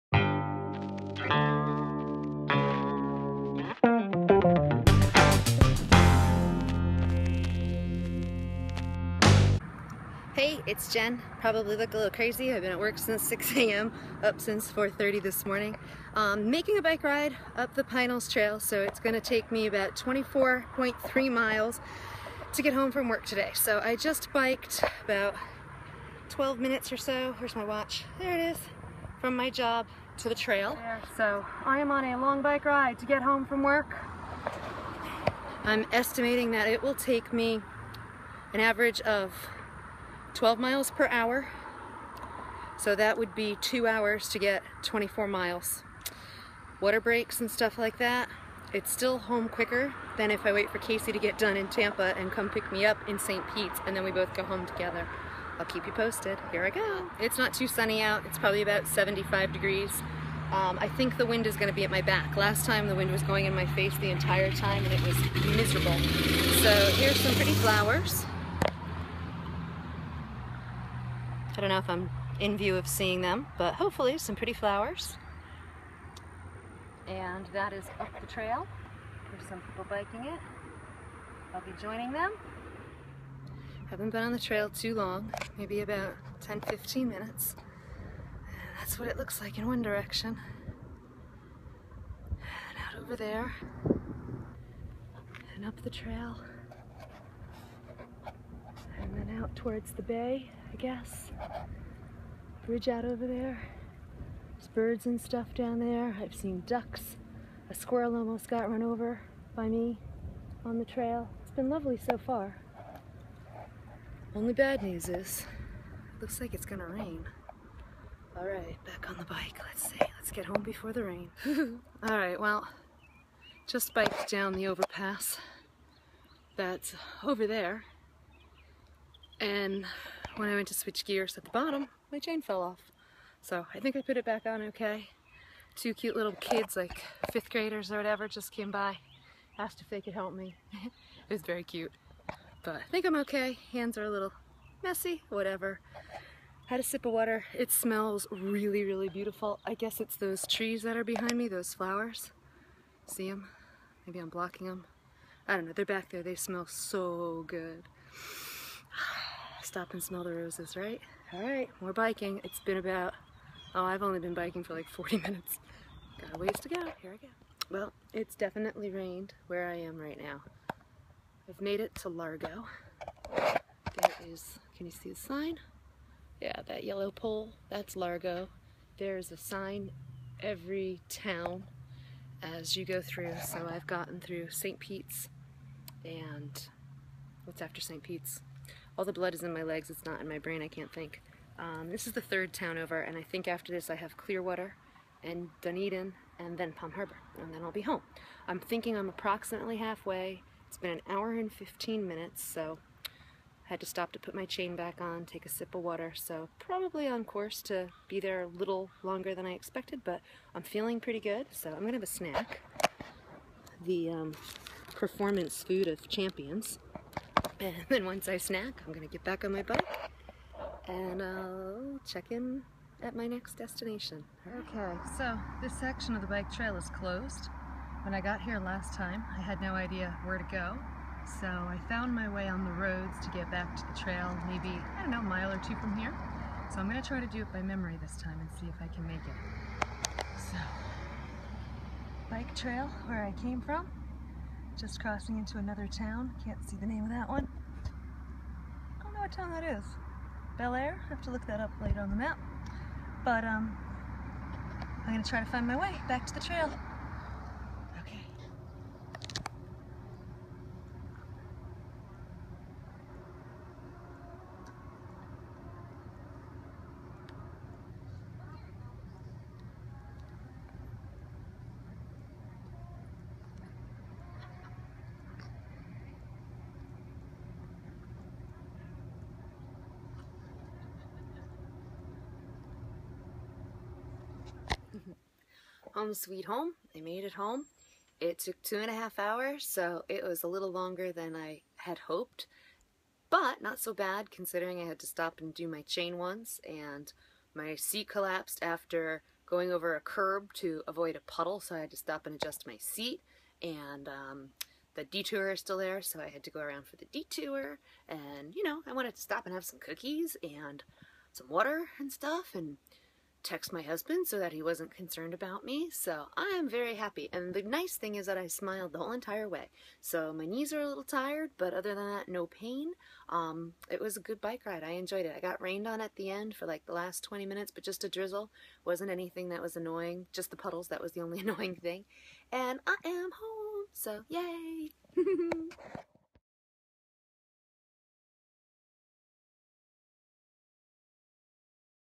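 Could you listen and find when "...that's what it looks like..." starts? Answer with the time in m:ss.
1:28.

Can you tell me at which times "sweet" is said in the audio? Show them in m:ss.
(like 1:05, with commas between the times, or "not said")
4:46.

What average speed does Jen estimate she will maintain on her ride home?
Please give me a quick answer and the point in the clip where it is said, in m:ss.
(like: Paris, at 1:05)
12 miles per hour, at 0:40.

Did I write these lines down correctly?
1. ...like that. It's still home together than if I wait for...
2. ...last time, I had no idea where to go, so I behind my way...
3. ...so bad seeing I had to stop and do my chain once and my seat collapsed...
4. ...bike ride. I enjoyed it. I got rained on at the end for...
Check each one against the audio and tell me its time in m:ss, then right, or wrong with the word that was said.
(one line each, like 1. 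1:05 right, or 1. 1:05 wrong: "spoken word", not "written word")
1. 0:47 wrong: "quicker", not "together"
2. 3:48 wrong: "found", not "behind"
3. 4:53 wrong: "considering", not "seeing"
4. 5:24 right.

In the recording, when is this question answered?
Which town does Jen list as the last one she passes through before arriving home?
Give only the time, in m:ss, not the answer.
3:16.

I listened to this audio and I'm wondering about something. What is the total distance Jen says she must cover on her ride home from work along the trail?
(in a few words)
24.3 miles.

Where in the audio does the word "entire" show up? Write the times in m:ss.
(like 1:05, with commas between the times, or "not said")
1:04, 5:19.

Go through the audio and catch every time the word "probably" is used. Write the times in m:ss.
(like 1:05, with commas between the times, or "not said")
0:11, 0:58, 3:26.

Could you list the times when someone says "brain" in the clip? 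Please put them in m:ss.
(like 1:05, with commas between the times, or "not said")
3:10.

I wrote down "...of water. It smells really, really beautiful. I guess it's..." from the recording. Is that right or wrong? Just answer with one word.
right.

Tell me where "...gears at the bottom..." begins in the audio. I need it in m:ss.
2:11.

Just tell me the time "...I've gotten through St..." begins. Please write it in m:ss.
3:03.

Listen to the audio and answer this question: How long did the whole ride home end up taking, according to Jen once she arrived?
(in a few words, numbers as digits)
2.5 hours.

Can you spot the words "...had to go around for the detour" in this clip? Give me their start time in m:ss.
5:06.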